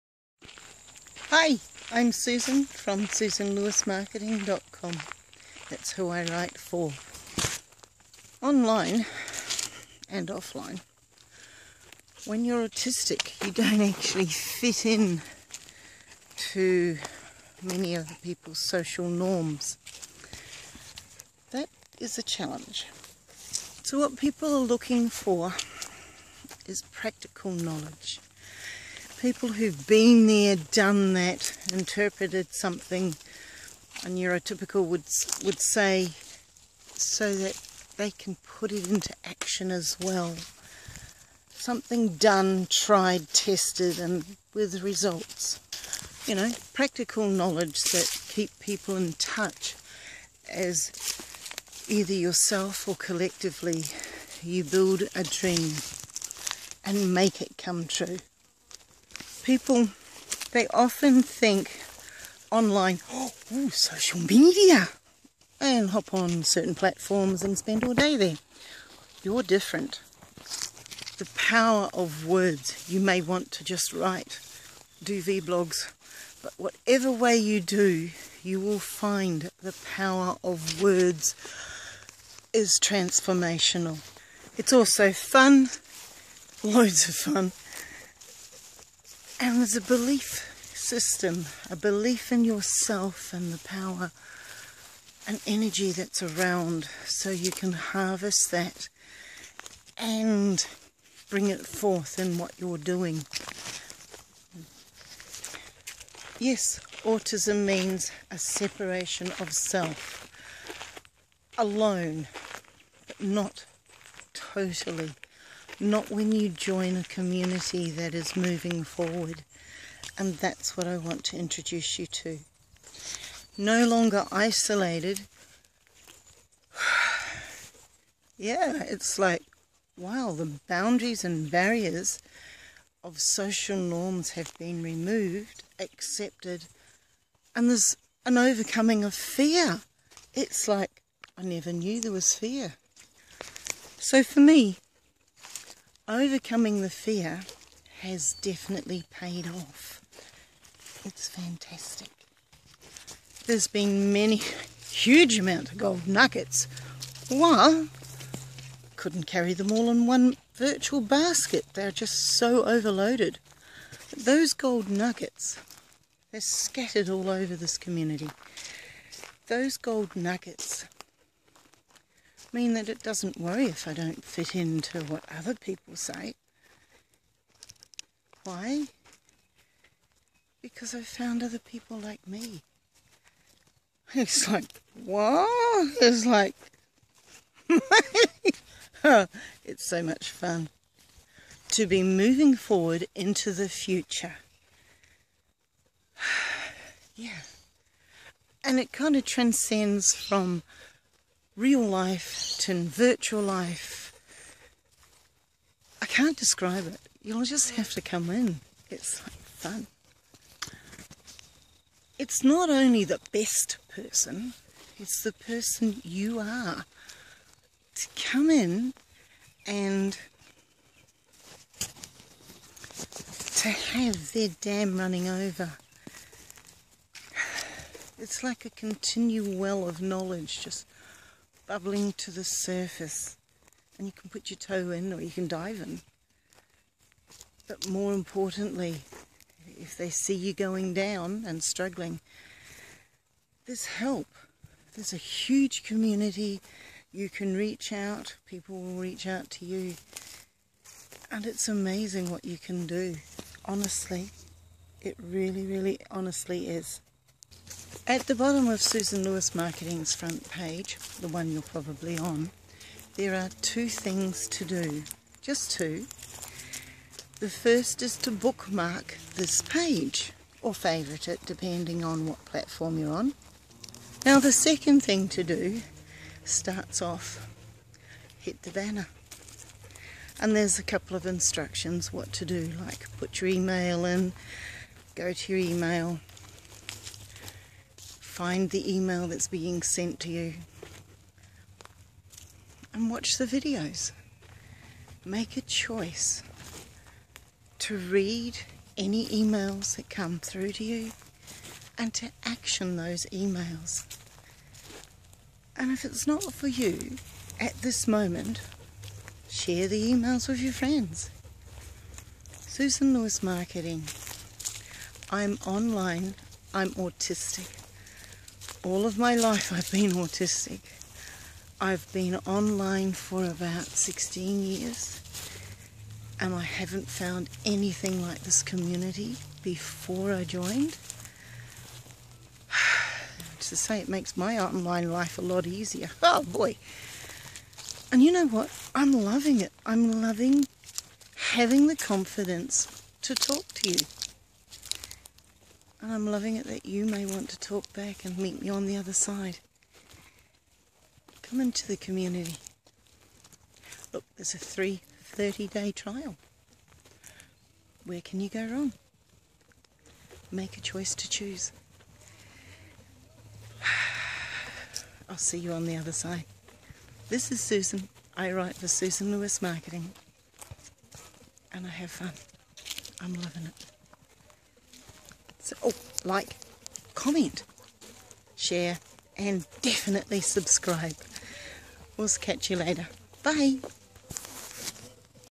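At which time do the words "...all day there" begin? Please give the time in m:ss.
1:07.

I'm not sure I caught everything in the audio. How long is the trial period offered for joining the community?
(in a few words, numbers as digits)
30 day.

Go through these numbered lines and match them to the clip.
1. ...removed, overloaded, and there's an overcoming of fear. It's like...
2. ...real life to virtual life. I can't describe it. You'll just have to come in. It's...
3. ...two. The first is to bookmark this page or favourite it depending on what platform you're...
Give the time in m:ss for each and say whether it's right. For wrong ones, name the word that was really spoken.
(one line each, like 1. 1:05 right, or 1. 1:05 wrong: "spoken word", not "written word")
1. 2:14 wrong: "accepted", not "overloaded"
2. 3:21 right
3. 4:25 right.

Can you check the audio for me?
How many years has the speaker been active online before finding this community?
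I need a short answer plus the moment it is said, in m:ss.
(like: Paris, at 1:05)
16 years, at 5:23.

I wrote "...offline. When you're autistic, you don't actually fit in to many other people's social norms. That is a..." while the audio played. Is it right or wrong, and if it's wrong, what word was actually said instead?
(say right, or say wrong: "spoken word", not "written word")
right.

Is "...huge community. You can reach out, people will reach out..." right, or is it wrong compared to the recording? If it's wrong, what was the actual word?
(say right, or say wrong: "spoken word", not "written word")
right.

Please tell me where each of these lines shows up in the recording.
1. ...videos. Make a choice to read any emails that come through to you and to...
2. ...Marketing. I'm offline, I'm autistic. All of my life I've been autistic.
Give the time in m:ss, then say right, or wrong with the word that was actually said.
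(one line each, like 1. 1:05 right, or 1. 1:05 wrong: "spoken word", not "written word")
1. 4:53 right
2. 5:13 wrong: "online", not "offline".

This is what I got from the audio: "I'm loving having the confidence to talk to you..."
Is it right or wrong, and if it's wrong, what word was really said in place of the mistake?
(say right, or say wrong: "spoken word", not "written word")
right.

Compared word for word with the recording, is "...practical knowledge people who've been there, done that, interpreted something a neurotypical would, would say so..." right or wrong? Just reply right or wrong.
right.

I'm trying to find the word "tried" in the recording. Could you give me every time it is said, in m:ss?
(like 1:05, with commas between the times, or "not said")
0:42.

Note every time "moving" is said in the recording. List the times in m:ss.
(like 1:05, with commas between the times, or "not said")
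1:58, 3:12.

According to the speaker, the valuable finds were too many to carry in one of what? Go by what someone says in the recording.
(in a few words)
Virtual basket.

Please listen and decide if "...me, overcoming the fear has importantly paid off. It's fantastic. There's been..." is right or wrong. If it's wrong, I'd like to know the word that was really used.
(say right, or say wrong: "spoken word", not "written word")
wrong: "definitely", not "importantly".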